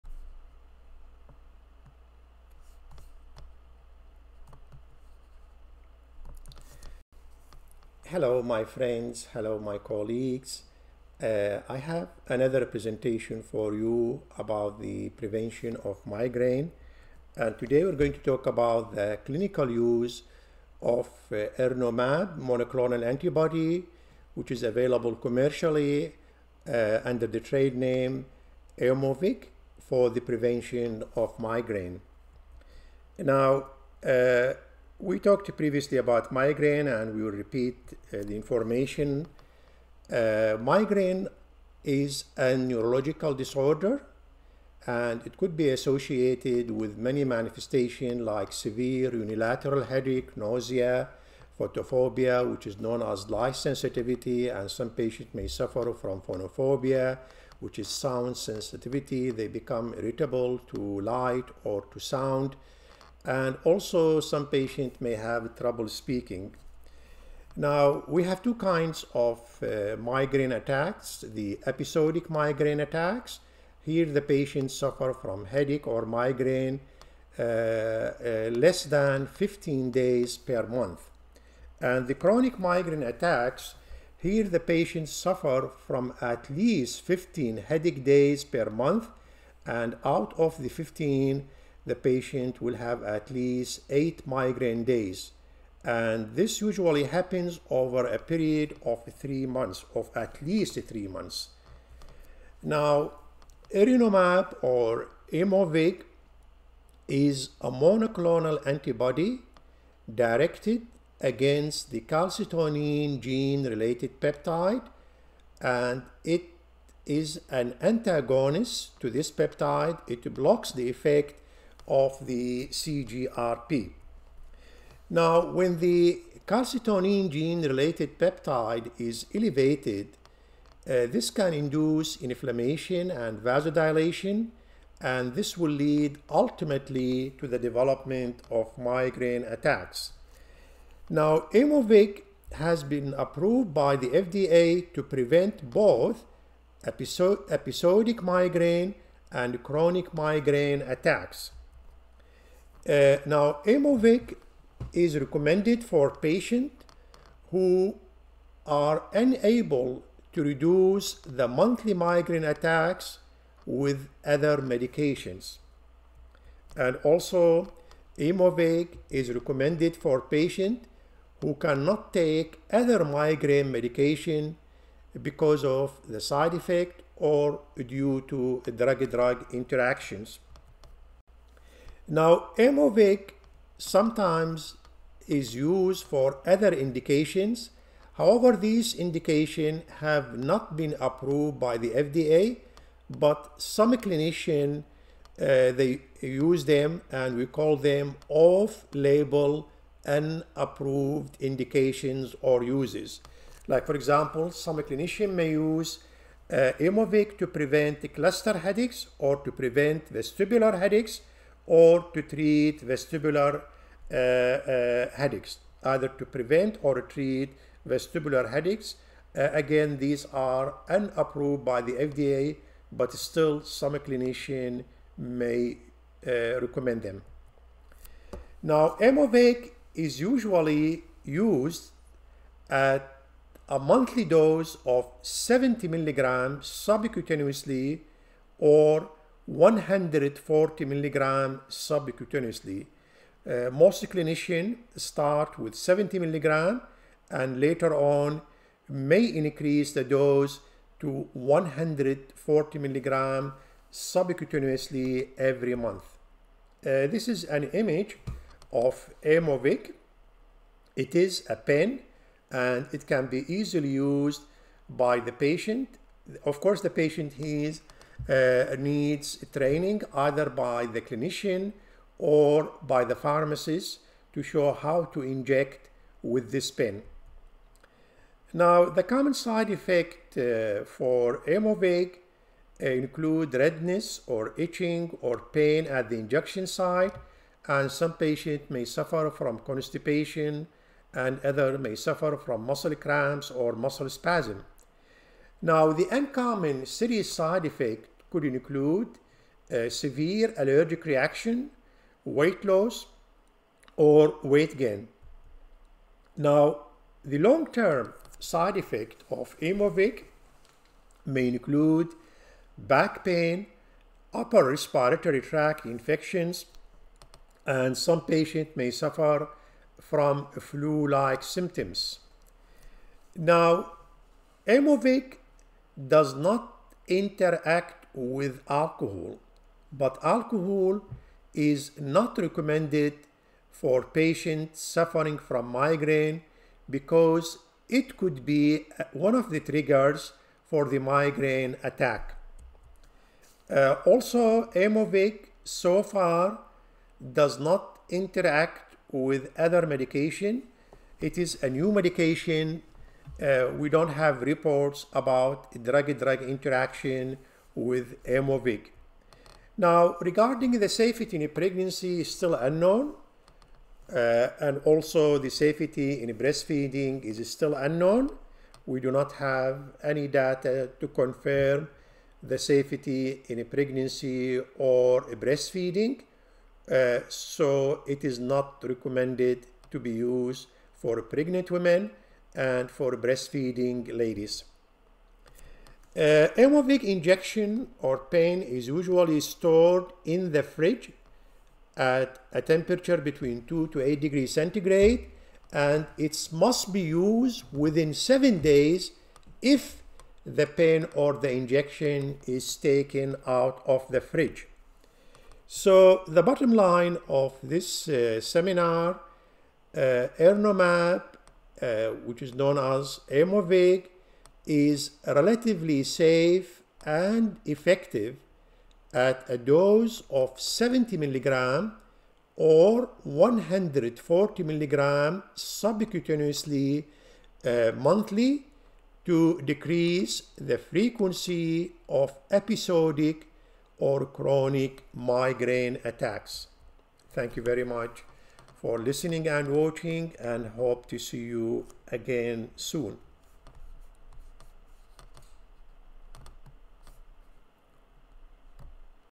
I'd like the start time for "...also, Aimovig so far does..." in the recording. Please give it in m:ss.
5:44.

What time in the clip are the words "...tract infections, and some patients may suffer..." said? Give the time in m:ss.
5:15.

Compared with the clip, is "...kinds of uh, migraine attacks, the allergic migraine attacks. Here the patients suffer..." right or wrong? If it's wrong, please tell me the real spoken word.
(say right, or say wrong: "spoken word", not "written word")
wrong: "episodic", not "allergic".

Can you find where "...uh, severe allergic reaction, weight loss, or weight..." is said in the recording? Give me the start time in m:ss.
4:59.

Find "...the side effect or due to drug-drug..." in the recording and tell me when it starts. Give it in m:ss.
2:56.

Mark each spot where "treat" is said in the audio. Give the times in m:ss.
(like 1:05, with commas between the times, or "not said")
3:32, 3:37.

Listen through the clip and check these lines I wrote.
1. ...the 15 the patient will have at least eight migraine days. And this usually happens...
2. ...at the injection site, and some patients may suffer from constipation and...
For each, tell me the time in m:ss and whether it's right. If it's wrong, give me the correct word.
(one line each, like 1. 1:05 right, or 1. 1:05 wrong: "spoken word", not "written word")
1. 1:30 right
2. 4:45 right.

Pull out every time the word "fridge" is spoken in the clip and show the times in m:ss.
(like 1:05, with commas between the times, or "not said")
6:30, 6:44.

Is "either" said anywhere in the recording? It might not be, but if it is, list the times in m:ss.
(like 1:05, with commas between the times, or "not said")
3:35, 4:30.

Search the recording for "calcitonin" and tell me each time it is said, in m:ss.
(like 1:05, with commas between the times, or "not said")
1:52, 2:06.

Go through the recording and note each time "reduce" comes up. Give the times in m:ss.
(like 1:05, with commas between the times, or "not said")
2:40.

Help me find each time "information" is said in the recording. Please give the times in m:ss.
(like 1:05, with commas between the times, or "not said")
0:38.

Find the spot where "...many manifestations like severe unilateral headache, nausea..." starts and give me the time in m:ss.
0:46.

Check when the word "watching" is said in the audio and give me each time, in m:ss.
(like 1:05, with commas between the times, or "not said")
7:19.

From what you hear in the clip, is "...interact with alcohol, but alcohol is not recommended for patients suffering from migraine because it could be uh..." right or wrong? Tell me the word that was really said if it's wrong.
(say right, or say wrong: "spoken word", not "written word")
right.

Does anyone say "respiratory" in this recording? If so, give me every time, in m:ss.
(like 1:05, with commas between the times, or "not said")
5:14.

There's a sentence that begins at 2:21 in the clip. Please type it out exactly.
Now, Aimovig has been approved by the FDA to prevent both episodic migraine and chronic migraine attacks.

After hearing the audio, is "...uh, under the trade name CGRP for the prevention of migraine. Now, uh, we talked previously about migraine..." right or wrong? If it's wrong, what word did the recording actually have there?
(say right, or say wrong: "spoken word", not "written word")
wrong: "Aimovig", not "CGRP".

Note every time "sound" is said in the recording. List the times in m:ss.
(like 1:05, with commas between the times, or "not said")
0:57, 1:01.